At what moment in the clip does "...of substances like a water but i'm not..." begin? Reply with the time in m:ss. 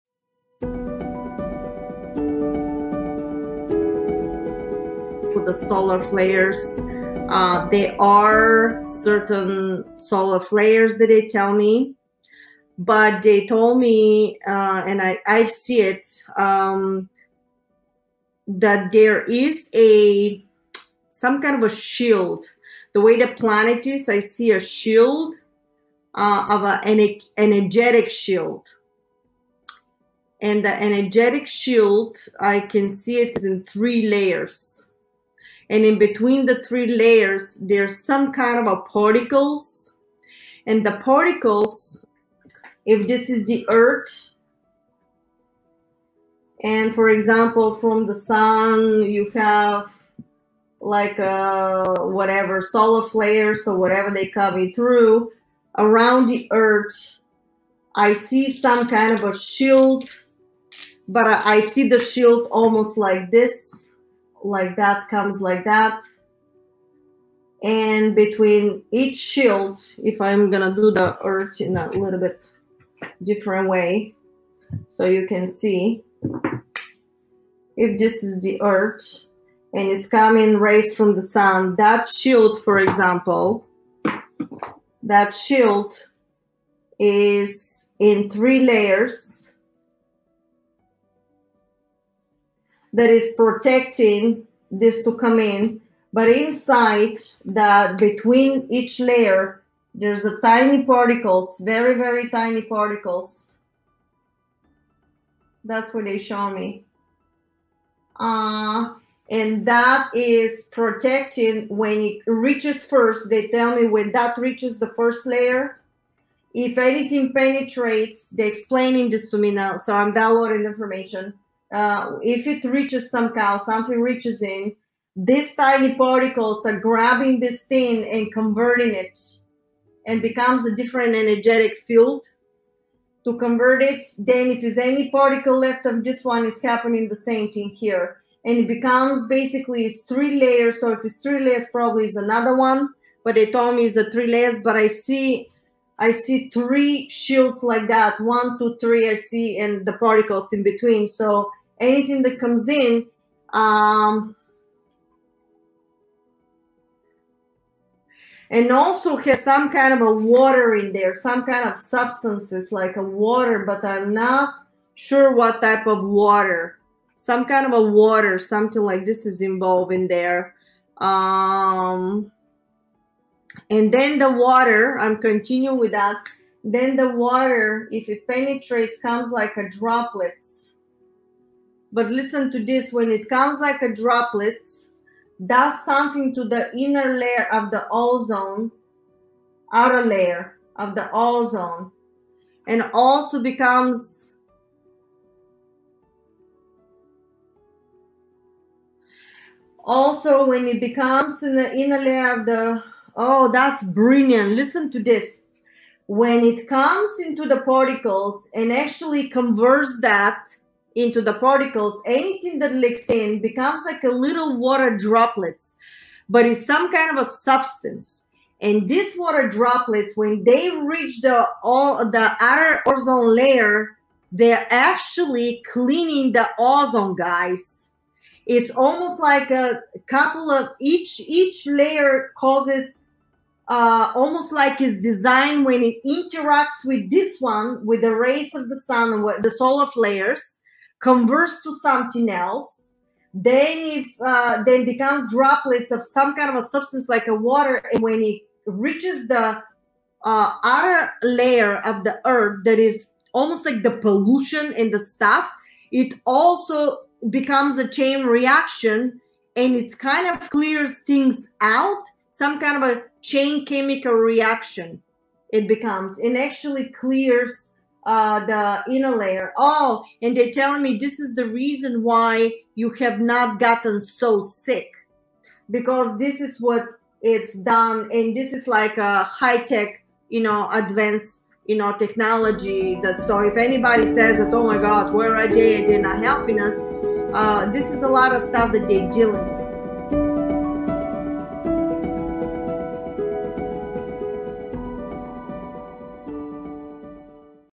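2:41.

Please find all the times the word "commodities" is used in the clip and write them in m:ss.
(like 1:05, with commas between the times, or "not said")
not said.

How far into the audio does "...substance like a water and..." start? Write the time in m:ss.
4:06.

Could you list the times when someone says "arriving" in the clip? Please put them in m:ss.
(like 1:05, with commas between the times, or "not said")
not said.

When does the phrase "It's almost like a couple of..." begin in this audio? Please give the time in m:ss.
3:48.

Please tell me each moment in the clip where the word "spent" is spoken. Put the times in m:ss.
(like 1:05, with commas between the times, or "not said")
not said.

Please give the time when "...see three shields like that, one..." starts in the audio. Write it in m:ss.
2:26.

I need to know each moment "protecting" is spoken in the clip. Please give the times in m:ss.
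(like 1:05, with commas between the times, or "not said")
1:33, 1:50.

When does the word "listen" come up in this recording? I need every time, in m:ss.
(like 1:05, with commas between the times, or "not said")
3:02, 3:24.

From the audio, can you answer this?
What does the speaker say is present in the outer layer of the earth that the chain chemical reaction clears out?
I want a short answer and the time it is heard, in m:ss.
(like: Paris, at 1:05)
Pollution, at 4:13.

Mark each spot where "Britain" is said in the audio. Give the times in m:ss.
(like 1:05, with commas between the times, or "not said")
not said.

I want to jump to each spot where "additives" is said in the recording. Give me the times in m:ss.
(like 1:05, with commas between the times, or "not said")
not said.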